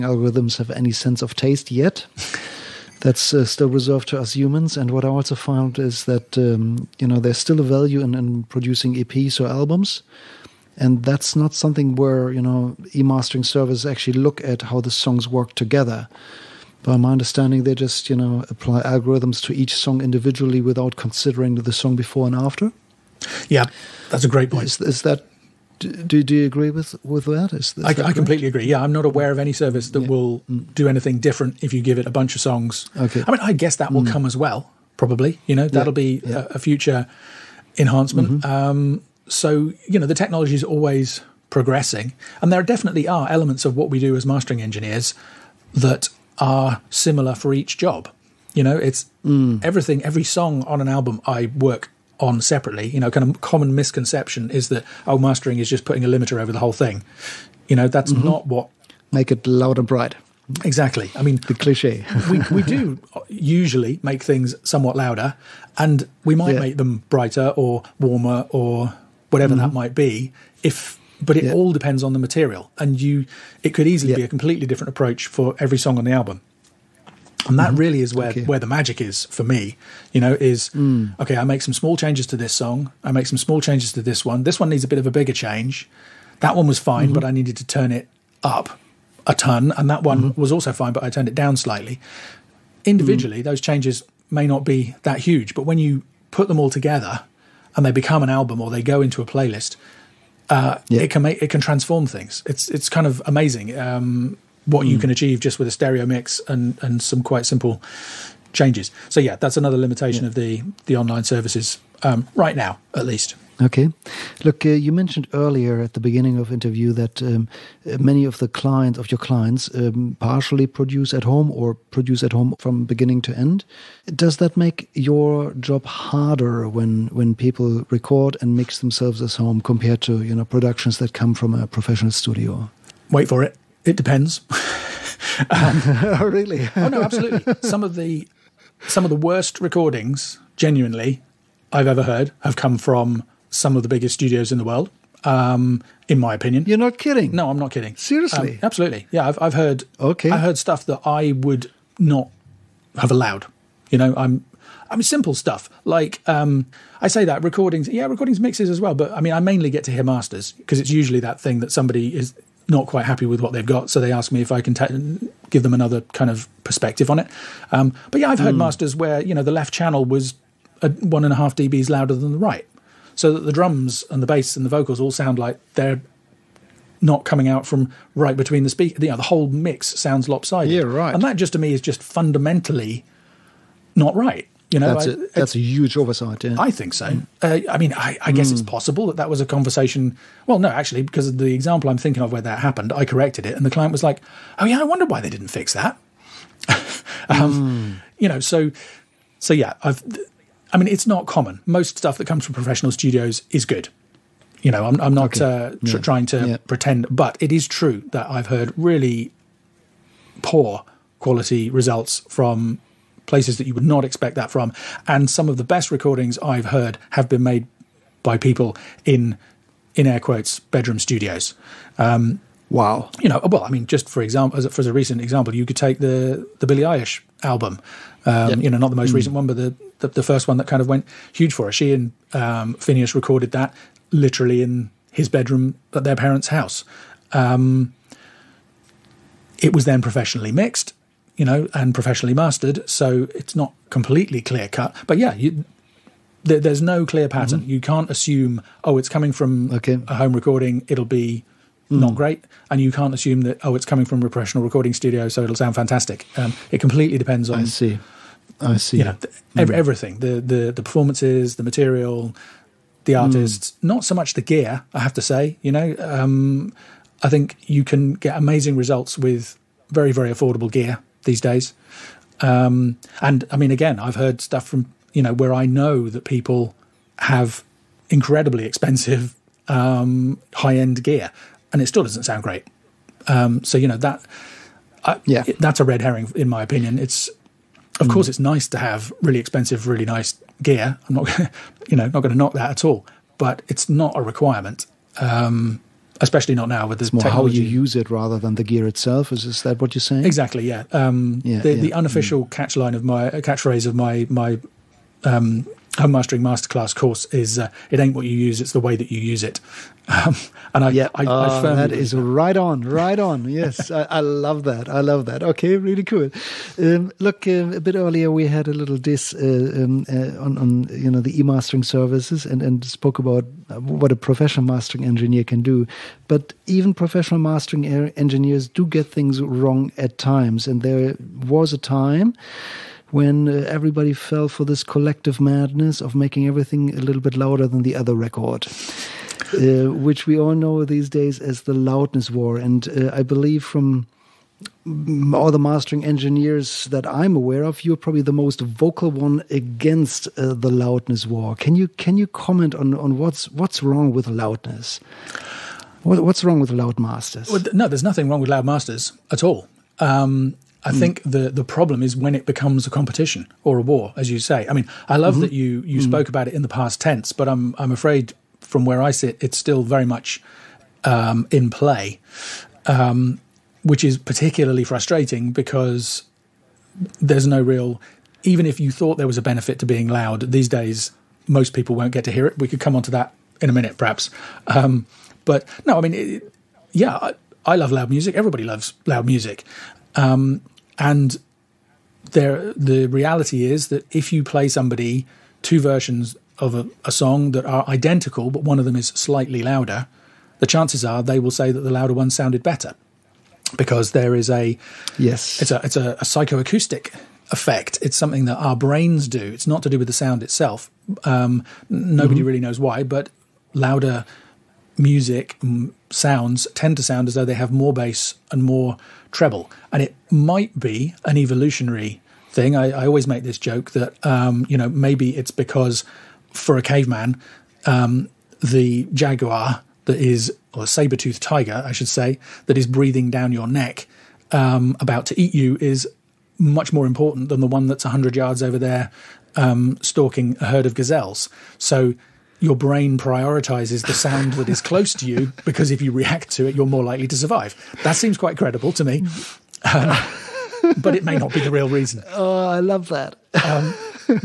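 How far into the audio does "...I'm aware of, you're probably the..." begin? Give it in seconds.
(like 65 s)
347 s.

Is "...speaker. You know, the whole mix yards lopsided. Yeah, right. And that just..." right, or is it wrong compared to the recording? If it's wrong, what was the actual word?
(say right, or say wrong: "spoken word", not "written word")
wrong: "sounds", not "yards".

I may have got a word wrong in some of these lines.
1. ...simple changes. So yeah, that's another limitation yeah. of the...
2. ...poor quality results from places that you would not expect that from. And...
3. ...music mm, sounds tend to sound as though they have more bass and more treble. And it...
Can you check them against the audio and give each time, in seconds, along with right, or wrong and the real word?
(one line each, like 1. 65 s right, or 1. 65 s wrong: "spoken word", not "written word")
1. 107 s right
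2. 210 s right
3. 414 s right.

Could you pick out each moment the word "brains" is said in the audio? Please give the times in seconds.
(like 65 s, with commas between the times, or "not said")
408 s, 442 s.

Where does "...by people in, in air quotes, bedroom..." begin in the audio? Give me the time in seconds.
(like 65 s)
218 s.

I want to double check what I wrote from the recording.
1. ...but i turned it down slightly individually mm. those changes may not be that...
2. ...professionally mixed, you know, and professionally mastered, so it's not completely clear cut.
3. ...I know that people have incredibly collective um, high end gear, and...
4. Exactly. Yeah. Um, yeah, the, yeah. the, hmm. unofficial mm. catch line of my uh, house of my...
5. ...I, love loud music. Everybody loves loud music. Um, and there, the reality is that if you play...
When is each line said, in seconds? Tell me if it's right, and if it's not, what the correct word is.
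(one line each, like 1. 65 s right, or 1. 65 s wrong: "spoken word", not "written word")
1. 90 s right
2. 240 s right
3. 275 s wrong: "expensive", not "collective"
4. 300 s wrong: "catchphrase", not "house"
5. 387 s right.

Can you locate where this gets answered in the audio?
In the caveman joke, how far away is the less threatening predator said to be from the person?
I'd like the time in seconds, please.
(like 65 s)
438 s.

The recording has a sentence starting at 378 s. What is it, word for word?
Even if you thought there was a benefit to being loud, these days most people won't get to hear it.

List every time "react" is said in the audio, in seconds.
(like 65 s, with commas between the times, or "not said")
446 s.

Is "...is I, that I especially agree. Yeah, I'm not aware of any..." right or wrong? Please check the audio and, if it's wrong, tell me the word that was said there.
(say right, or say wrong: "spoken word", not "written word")
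wrong: "completely", not "especially".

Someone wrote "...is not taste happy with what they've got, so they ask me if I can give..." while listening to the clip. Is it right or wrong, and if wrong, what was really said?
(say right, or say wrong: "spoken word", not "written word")
wrong: "quite", not "taste".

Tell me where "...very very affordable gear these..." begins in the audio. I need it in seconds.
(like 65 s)
269 s.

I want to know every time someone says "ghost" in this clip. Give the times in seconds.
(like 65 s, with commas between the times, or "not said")
not said.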